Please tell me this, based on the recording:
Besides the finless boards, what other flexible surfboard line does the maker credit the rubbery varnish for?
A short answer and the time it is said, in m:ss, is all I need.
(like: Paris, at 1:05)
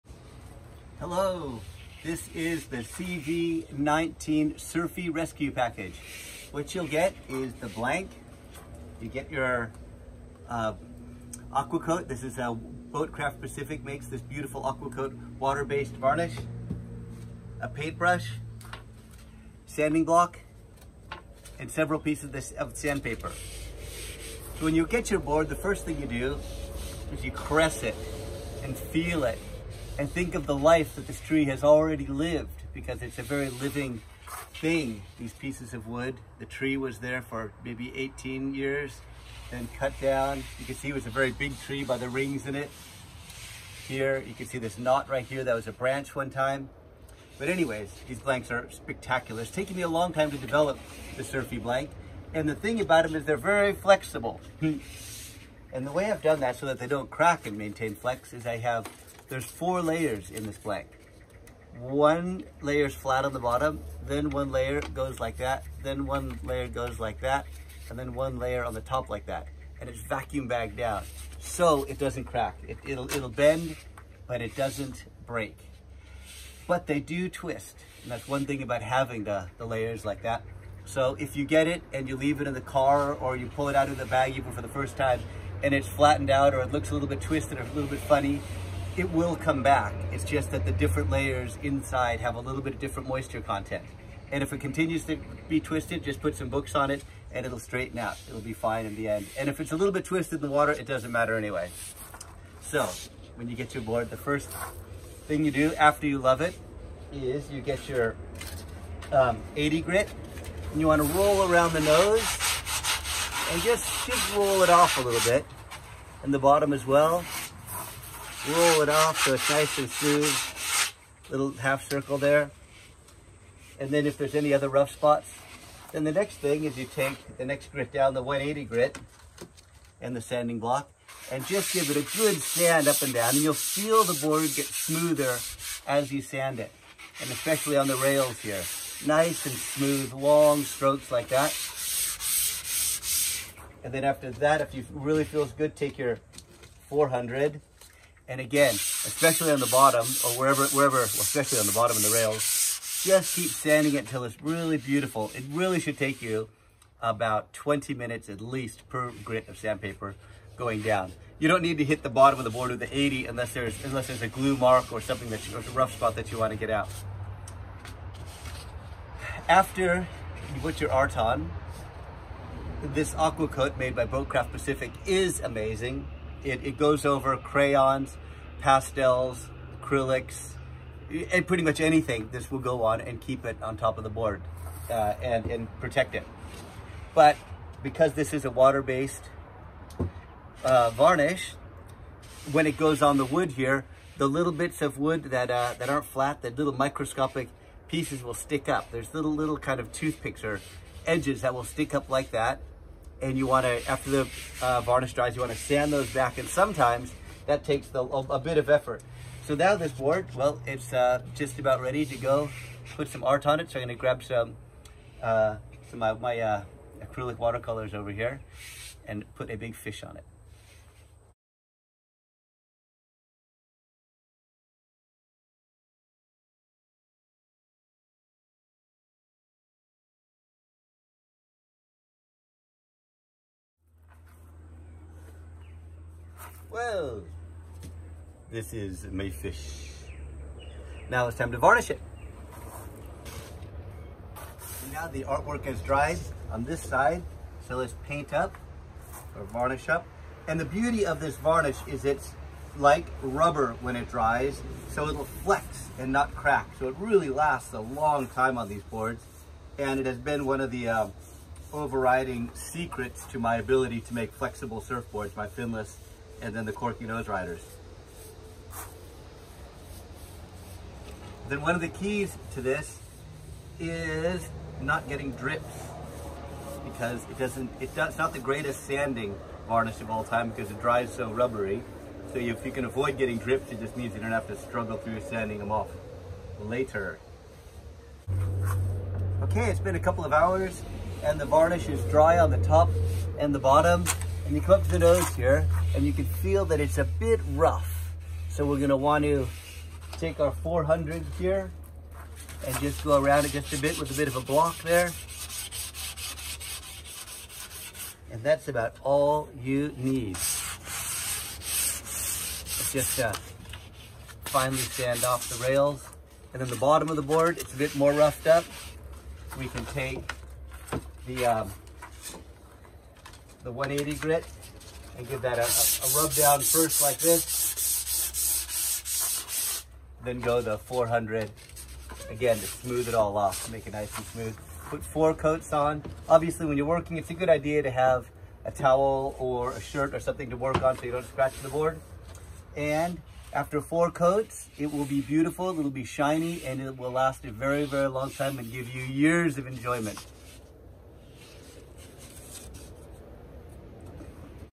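Corky Nose Riders, at 4:26.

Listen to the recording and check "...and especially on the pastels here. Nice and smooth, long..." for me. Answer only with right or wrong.
wrong.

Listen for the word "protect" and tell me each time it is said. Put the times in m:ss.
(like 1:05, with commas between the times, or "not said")
3:05.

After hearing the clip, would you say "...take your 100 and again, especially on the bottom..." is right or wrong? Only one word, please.
wrong.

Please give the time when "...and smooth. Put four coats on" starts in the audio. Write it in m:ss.
5:34.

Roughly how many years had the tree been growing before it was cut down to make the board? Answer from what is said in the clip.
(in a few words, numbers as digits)
18.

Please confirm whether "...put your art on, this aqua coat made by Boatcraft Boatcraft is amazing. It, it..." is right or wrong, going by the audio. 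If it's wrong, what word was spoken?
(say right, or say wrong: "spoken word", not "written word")
wrong: "Pacific", not "Boatcraft".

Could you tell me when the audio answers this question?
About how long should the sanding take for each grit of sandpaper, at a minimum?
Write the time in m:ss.
2:37.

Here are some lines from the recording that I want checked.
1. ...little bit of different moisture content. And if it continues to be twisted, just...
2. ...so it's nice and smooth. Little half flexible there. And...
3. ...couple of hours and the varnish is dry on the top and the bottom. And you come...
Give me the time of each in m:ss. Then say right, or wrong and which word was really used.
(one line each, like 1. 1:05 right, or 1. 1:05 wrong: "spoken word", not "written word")
1. 1:32 right
2. 1:59 wrong: "circle", not "flexible"
3. 4:49 right.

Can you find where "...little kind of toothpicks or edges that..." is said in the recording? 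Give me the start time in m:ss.
3:19.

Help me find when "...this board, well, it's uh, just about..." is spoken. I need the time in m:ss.
3:29.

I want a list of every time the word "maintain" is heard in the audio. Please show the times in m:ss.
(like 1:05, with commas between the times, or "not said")
0:57.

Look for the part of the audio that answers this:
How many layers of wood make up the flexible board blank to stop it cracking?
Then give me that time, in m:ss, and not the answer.
0:59.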